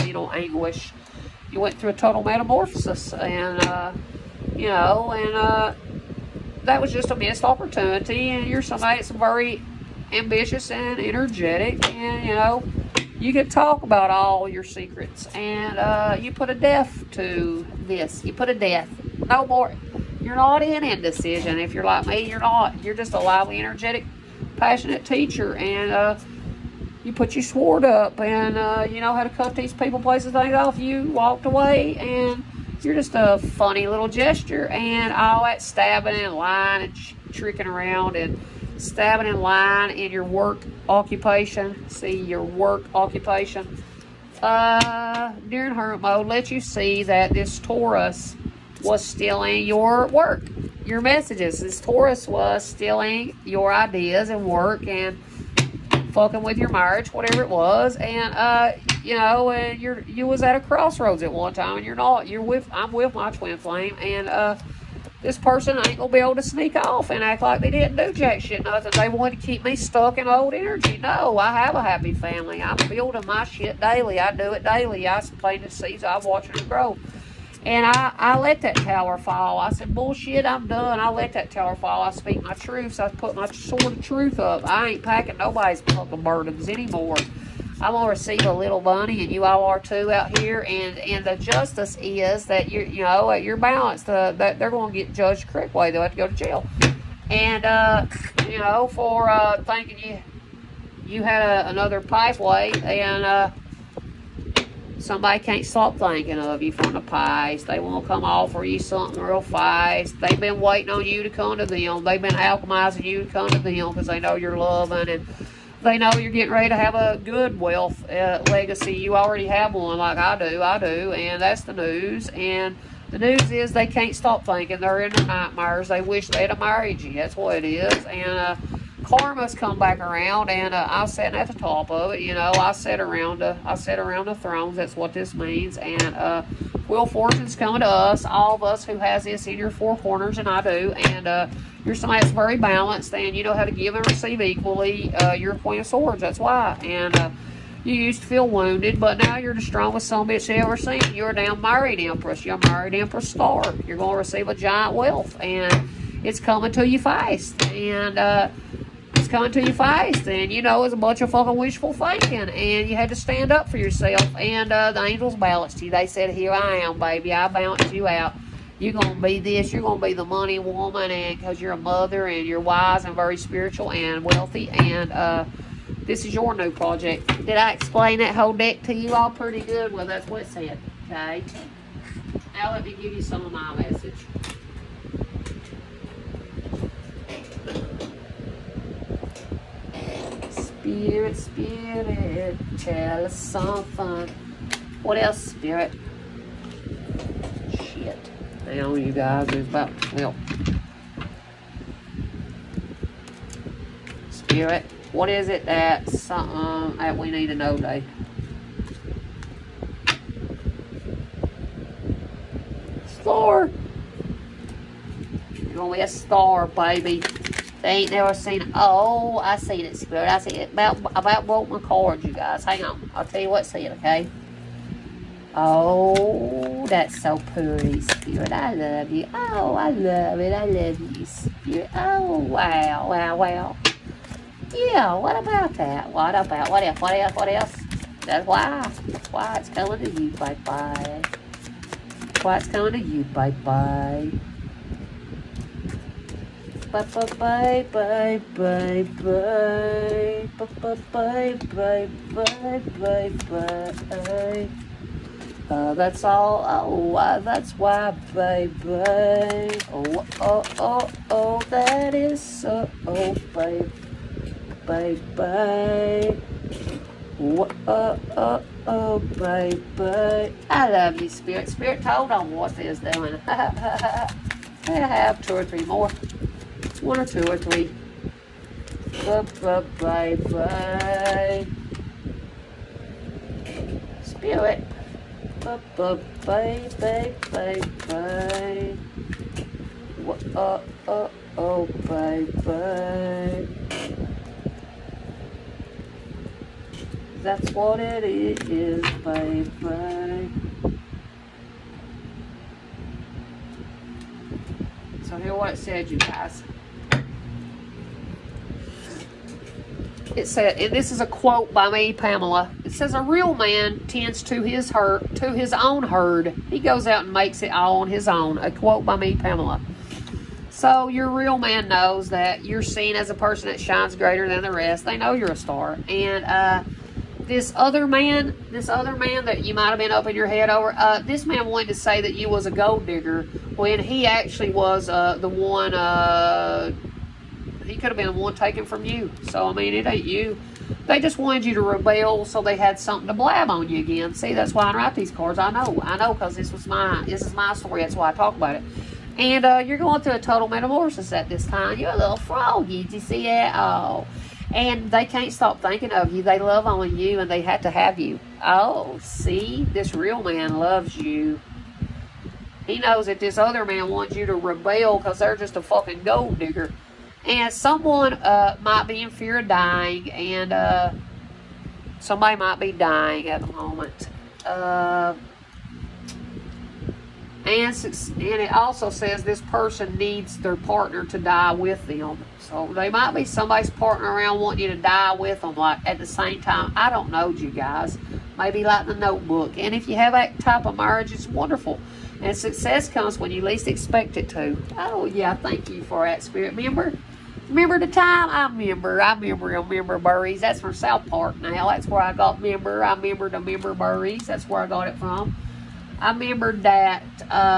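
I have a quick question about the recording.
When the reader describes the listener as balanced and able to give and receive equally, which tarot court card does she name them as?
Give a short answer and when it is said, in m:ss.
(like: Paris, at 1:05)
Queen of Swords, at 2:25.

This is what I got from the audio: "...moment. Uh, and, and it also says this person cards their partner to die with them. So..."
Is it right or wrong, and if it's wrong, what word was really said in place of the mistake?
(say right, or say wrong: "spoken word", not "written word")
wrong: "needs", not "cards".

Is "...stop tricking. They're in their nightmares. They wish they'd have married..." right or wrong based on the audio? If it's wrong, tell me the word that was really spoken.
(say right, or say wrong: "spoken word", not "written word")
wrong: "thinking", not "tricking".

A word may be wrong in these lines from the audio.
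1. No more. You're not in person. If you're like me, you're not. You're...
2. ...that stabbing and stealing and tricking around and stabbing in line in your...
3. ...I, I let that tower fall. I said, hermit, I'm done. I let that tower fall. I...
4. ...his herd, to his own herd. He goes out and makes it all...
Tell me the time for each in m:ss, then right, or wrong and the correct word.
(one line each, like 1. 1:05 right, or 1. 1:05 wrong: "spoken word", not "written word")
1. 0:19 wrong: "indecision", not "person"
2. 0:35 wrong: "lying", not "stealing"
3. 1:17 wrong: "bullshit", not "hermit"
4. 5:14 right.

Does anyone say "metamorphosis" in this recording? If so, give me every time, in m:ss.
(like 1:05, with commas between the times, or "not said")
0:02, 5:50.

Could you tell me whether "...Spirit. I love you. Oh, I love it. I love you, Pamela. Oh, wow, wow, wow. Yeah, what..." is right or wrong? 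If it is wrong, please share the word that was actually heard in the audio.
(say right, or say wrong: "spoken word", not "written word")
wrong: "Spirit", not "Pamela".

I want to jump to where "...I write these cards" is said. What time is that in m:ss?
5:44.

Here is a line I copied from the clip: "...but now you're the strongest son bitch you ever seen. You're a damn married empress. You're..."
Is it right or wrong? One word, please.
right.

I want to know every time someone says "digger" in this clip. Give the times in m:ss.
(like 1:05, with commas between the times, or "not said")
5:33, 6:06.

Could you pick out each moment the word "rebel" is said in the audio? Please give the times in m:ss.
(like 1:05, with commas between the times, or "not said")
5:41, 6:04.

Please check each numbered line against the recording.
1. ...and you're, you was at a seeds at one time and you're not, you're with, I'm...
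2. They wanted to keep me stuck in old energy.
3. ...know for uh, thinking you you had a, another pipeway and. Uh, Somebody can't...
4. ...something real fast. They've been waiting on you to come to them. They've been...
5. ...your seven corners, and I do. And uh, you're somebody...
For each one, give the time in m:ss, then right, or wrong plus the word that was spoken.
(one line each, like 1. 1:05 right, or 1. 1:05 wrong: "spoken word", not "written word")
1. 0:59 wrong: "crossroads", not "seeds"
2. 1:08 right
3. 1:38 right
4. 1:48 right
5. 2:19 wrong: "four", not "seven".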